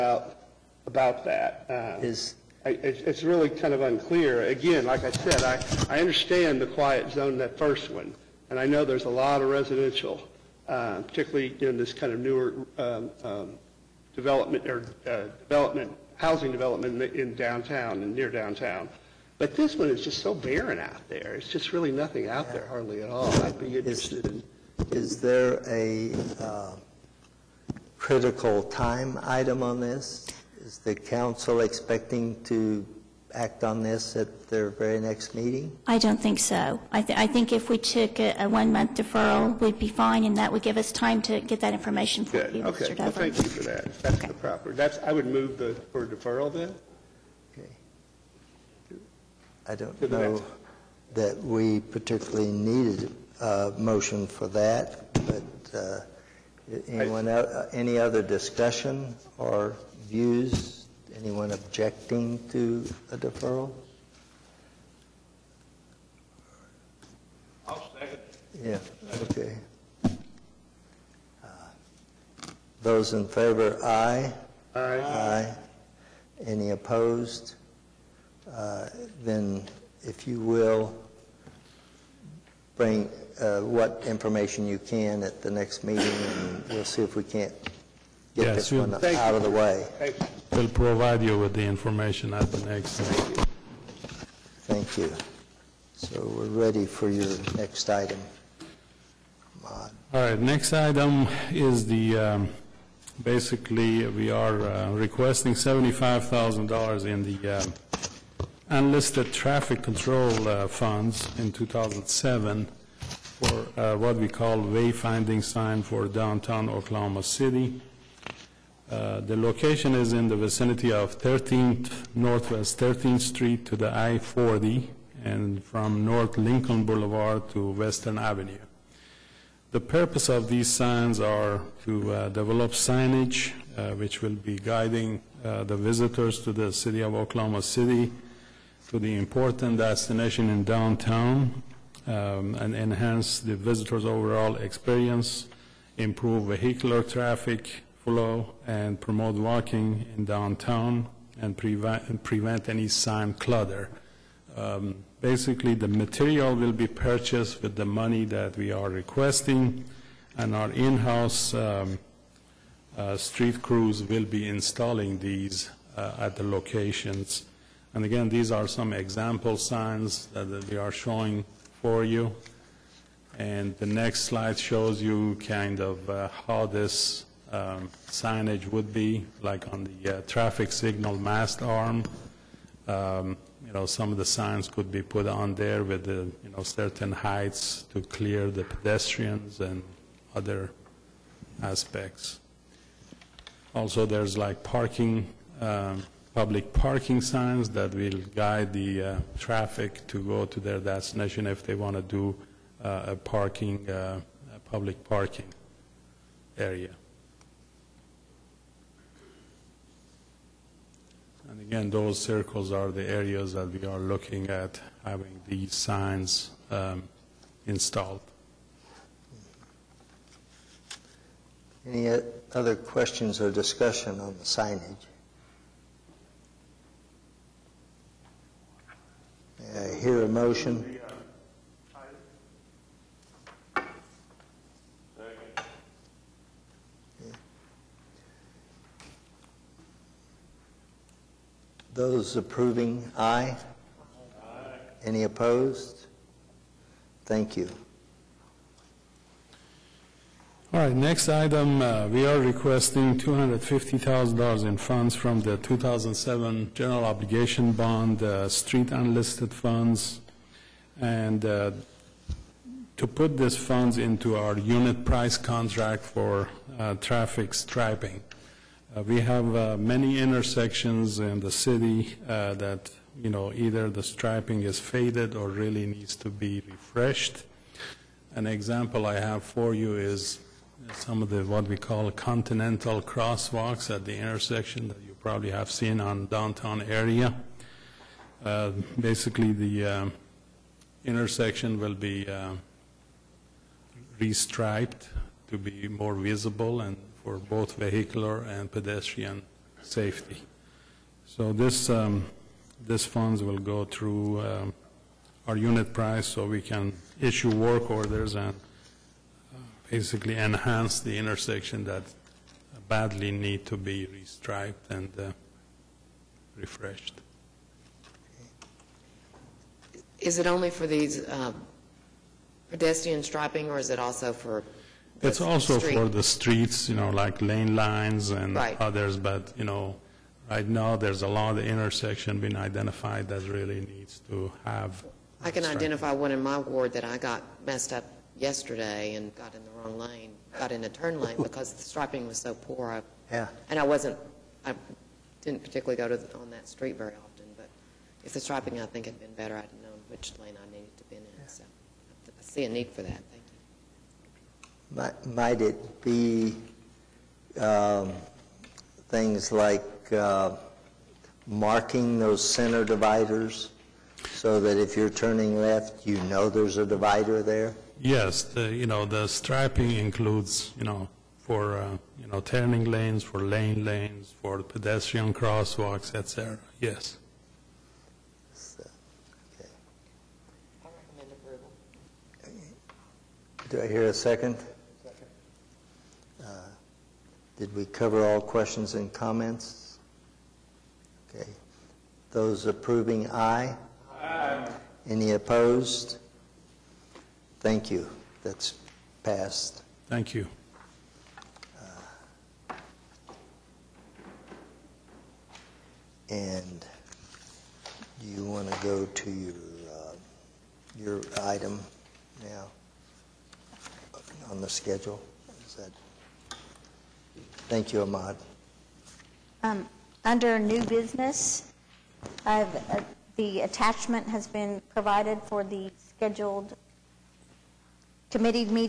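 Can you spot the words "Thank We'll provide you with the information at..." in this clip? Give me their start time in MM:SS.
01:29.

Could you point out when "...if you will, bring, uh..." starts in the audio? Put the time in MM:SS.
01:20.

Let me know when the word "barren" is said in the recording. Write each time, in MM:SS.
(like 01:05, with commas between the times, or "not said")
00:20.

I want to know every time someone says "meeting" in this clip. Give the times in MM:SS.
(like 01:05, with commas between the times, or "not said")
00:35, 01:25, 01:32.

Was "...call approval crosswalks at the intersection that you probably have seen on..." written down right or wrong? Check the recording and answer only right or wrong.
wrong.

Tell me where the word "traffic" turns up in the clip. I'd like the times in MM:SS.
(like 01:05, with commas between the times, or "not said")
01:49, 02:27, 03:00, 03:19, 04:27.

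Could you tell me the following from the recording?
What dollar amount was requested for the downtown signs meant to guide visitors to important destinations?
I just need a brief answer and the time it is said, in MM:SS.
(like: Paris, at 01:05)
$75,000, at 01:45.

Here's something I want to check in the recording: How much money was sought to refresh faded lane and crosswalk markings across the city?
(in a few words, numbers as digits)
$250,000.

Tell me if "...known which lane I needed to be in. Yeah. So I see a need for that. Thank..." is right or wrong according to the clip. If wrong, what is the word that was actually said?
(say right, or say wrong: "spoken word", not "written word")
right.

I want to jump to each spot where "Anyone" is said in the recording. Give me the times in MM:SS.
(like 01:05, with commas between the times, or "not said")
00:56, 01:01.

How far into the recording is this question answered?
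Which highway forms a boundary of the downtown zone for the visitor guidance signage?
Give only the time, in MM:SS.
02:03.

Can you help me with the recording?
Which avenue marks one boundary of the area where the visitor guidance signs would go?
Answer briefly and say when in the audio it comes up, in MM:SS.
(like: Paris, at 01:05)
Western Avenue, at 02:07.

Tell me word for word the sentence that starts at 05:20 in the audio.
Is it only for these uh, pedestrian striping, or is it also for?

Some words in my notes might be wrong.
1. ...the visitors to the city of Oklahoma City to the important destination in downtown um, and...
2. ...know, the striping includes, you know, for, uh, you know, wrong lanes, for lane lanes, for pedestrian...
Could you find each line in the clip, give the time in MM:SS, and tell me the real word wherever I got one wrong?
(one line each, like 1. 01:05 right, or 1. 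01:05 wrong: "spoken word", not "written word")
1. 02:15 right
2. 06:08 wrong: "turning", not "wrong".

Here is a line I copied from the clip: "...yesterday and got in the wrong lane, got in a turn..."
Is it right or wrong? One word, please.
right.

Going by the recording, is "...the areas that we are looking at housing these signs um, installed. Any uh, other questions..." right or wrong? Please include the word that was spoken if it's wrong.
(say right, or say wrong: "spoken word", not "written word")
wrong: "having", not "housing".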